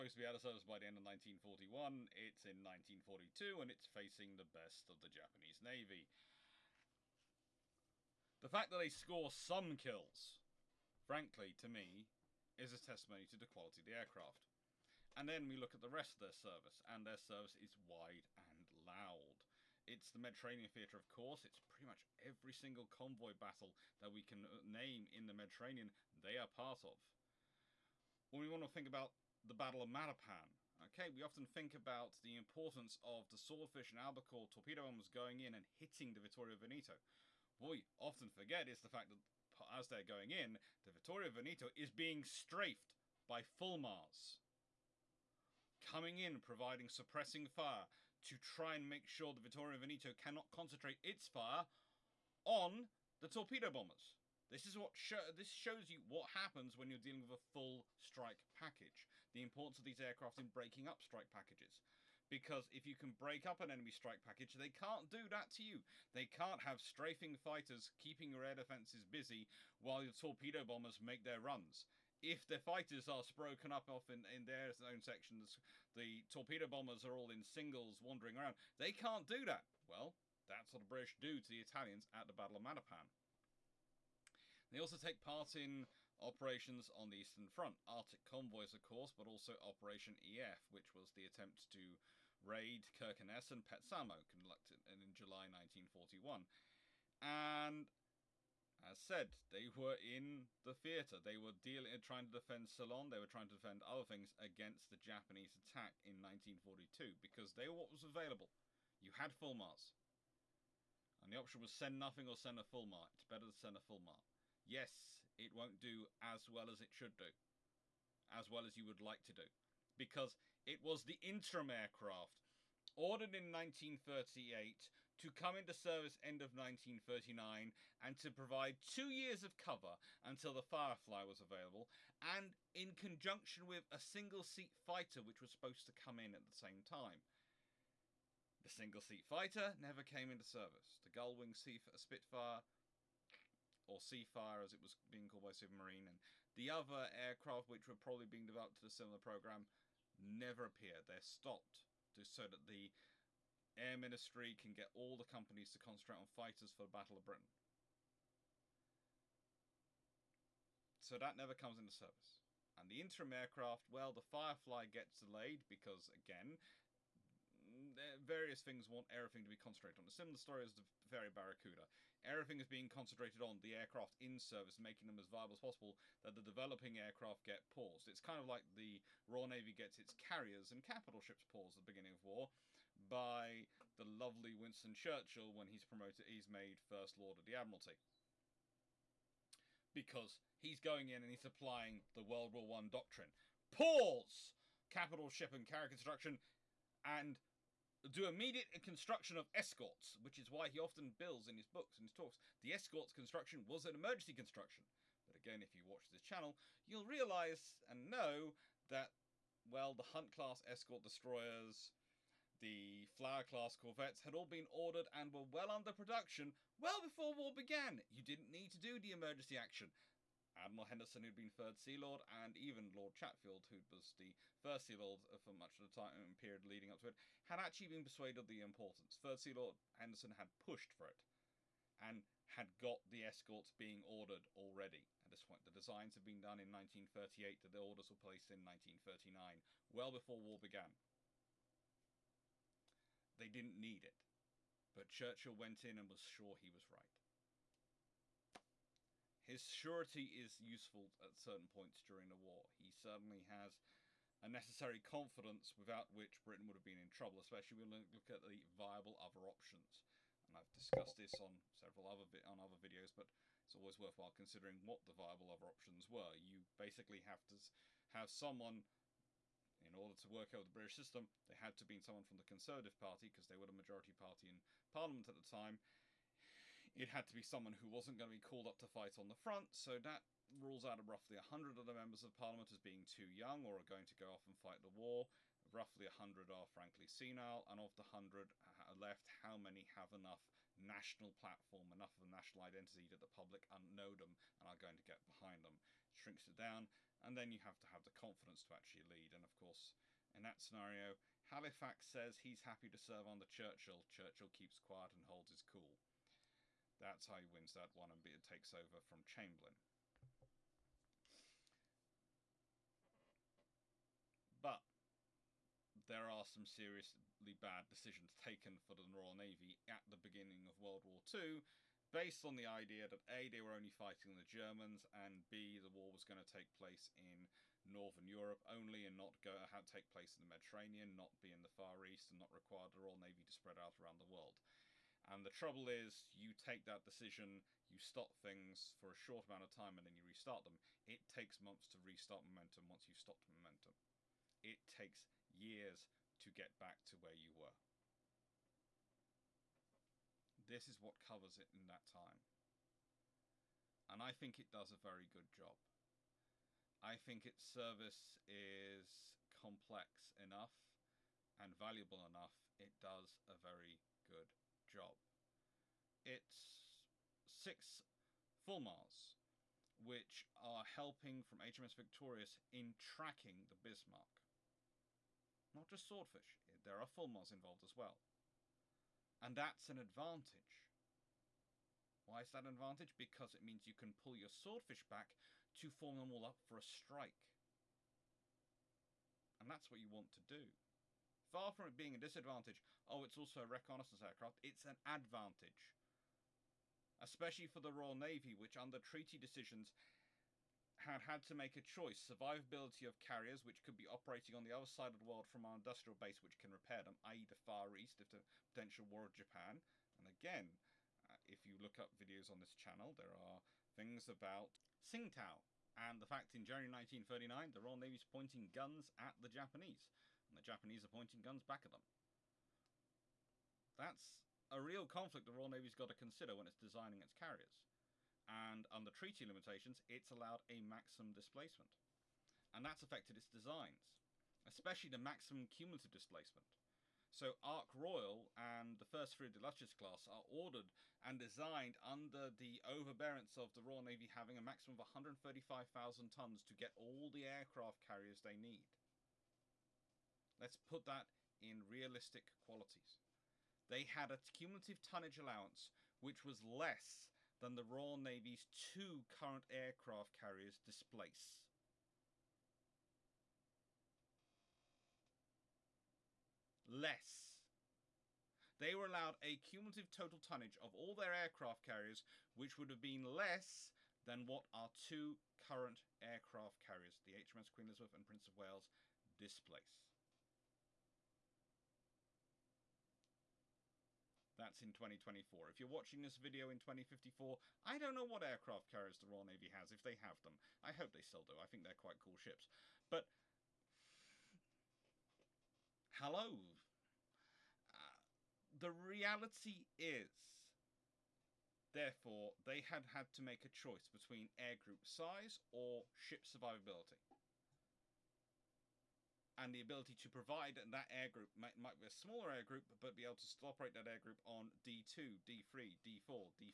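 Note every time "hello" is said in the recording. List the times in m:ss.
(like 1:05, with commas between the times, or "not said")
8:16.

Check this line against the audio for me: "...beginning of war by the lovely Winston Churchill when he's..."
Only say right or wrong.
right.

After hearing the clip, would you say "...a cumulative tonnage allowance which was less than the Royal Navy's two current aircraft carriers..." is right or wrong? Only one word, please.
right.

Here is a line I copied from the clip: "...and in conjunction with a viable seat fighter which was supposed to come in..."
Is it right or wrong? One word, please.
wrong.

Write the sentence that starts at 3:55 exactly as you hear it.
The designs had been done in 1938, the orders were placed in 1939, well before war began.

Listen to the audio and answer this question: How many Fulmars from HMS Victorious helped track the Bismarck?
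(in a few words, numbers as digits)
6.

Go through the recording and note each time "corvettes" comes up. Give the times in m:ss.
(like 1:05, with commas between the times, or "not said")
3:33.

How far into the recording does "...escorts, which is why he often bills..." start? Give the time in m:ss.
3:19.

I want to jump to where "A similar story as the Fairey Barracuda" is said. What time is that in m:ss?
2:50.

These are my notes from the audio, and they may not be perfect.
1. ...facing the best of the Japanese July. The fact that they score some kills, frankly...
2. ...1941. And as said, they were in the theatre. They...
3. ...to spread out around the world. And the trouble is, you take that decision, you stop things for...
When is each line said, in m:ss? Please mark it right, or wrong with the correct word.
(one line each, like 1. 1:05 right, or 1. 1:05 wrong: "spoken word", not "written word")
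1. 0:03 wrong: "Navy", not "July"
2. 1:35 right
3. 5:33 right.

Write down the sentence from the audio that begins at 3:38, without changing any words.
You didn't need to do the emergency action.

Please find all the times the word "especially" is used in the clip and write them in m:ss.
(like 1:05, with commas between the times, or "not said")
4:17, 6:37, 7:14.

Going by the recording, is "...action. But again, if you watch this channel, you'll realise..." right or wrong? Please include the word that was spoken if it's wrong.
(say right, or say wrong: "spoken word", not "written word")
wrong: "construction", not "action".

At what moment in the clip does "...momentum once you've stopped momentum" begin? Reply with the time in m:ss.
5:42.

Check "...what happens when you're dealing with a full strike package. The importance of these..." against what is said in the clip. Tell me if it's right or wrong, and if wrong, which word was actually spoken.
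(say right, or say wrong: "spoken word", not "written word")
right.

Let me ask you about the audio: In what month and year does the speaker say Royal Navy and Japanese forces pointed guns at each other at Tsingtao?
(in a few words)
January 1939.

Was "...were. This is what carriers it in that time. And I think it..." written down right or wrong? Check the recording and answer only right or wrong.
wrong.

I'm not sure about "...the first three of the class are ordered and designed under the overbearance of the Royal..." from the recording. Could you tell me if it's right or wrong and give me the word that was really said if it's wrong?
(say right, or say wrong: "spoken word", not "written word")
right.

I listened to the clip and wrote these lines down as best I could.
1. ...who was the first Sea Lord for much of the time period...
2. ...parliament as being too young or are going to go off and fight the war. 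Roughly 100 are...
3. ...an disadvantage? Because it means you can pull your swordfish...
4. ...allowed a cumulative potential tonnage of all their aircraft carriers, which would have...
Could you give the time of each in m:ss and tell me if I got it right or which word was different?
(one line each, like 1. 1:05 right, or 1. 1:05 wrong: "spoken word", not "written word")
1. 3:43 right
2. 4:42 right
3. 6:22 wrong: "advantage", not "disadvantage"
4. 7:49 wrong: "total", not "potential".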